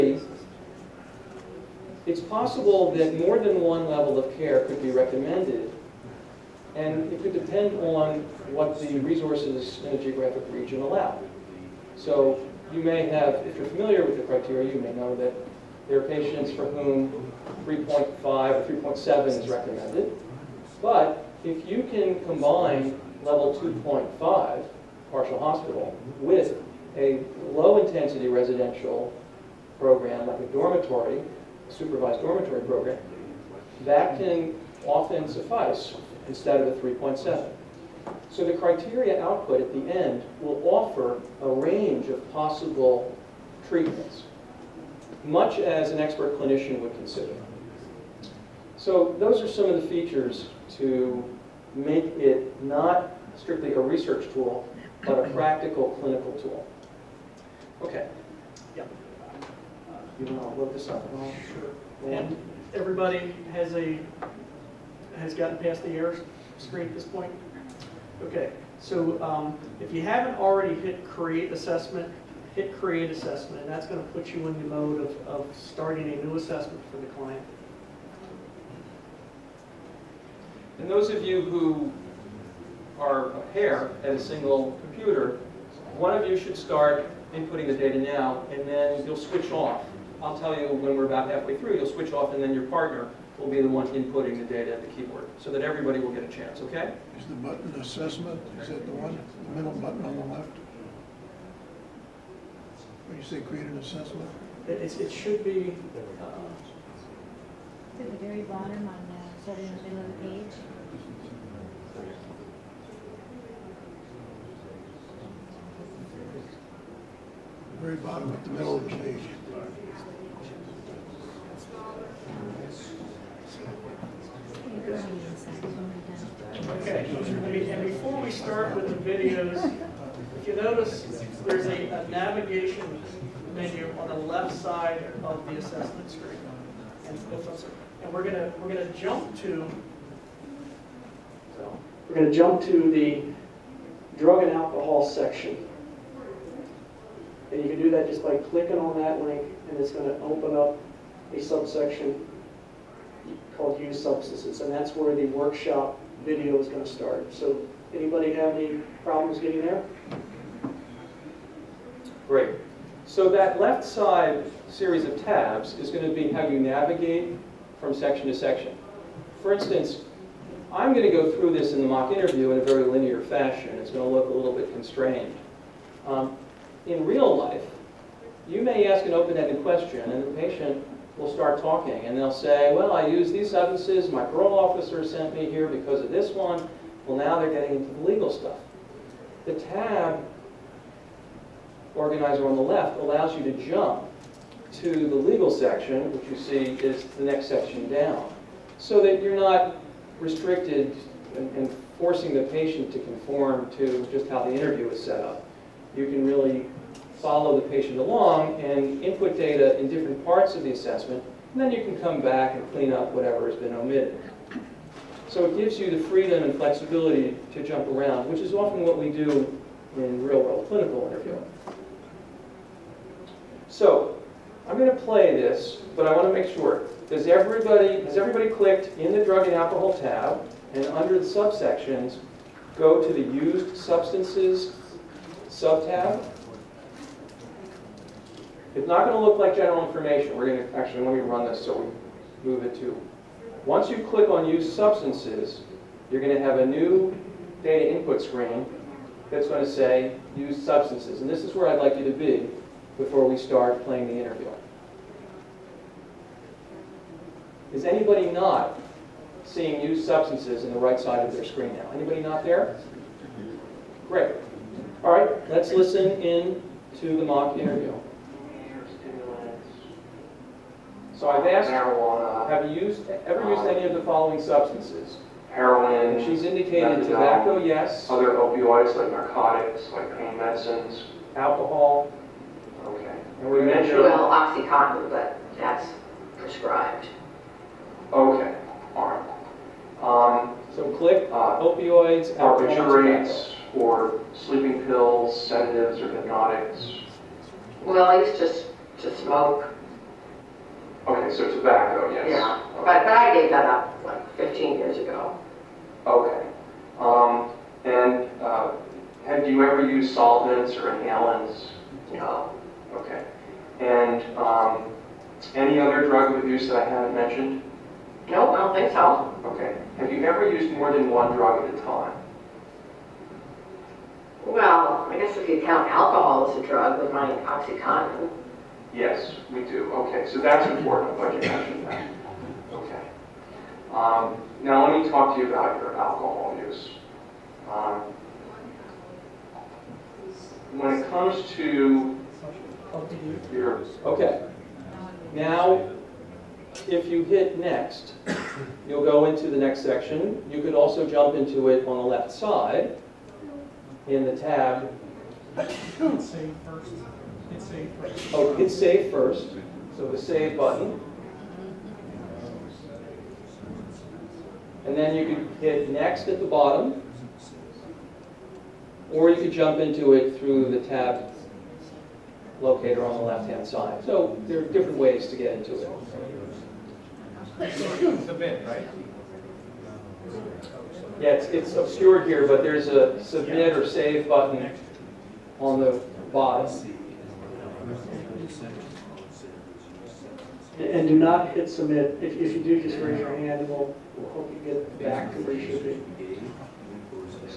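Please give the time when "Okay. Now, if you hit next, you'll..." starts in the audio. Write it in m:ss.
5:44.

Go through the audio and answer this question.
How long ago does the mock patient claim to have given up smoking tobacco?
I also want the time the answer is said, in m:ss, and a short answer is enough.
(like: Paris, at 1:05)
15 years, at 5:04.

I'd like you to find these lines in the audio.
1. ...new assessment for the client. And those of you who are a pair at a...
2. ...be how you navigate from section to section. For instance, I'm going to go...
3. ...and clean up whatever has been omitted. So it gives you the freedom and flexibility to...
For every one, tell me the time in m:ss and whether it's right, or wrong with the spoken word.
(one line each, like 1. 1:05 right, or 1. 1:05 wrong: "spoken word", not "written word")
1. 1:16 right
2. 2:46 right
3. 3:32 right.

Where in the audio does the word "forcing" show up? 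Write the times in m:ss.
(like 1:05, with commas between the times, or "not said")
3:21.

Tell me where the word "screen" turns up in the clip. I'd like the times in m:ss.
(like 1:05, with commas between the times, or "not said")
1:06, 2:16, 4:08, 4:21.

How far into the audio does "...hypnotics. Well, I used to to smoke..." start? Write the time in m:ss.
4:56.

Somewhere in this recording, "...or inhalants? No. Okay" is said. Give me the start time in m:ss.
5:10.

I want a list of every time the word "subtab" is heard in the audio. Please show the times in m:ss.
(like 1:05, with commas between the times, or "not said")
3:55.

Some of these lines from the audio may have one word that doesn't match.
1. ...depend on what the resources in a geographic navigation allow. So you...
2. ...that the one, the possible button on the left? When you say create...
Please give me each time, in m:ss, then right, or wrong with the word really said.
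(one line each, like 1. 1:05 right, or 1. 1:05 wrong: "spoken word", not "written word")
1. 0:07 wrong: "region", not "navigation"
2. 1:38 wrong: "middle", not "possible".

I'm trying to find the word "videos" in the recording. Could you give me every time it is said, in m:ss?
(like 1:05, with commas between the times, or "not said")
2:09, 2:36.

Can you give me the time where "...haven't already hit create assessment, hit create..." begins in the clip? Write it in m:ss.
1:10.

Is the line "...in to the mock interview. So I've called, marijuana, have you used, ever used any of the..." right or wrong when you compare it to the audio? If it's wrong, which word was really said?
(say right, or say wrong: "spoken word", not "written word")
wrong: "asked", not "called".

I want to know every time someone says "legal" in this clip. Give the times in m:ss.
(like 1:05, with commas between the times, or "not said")
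3:08, 3:15.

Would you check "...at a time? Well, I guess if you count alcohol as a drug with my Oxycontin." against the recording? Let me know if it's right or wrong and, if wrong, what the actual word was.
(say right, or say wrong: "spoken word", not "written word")
right.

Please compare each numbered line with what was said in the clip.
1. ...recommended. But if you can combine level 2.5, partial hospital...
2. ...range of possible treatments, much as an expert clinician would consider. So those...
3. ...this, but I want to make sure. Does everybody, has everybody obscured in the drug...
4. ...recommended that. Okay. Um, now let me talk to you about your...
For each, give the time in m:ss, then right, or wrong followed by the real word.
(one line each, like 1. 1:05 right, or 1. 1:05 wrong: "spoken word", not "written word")
1. 0:19 right
2. 0:41 right
3. 3:45 wrong: "clicked", not "obscured"
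4. 5:31 wrong: "mentioned", not "recommended".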